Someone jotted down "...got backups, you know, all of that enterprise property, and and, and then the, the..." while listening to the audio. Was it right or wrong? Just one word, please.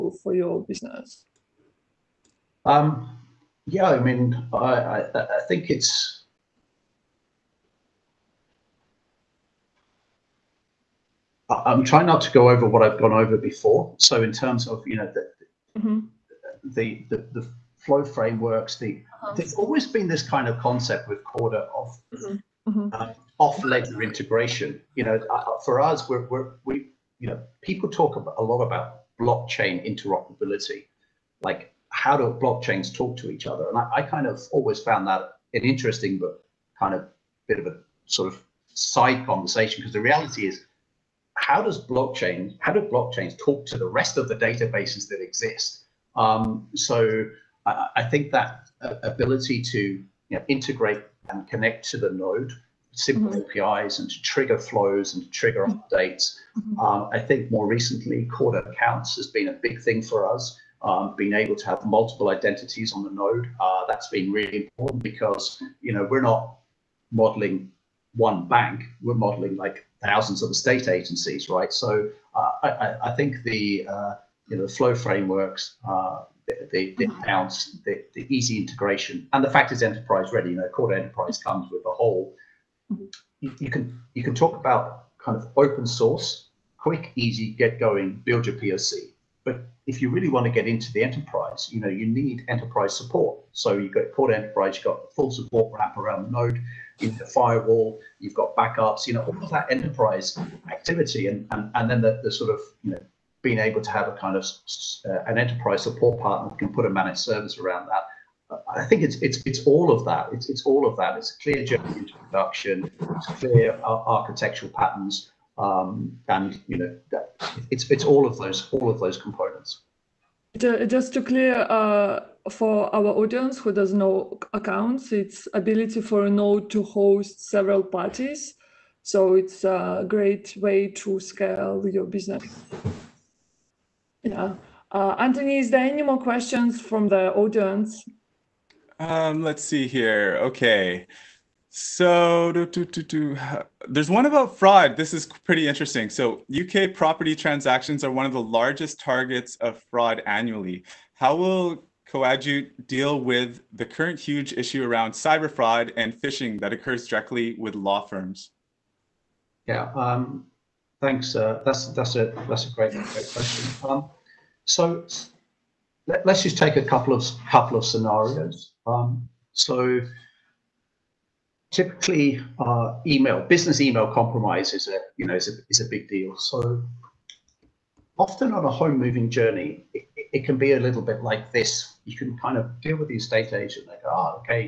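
wrong.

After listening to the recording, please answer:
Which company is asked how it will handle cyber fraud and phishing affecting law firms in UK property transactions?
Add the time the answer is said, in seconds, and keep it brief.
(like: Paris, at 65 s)
Coadjute, at 152 s.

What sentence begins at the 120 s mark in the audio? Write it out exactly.
Just to clear uh, for our audience who does know accounts, it's ability for a node to host several parties.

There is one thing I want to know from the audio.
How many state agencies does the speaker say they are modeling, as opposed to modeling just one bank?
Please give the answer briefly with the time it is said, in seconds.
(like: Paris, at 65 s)
Thousands, at 70 s.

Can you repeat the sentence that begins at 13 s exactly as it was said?
So in terms of you know the mm-hmm.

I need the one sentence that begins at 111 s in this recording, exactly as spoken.
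It's a clear journey into production.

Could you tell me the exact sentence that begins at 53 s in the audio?
APIs, and to trigger flows and to trigger mm-hmm.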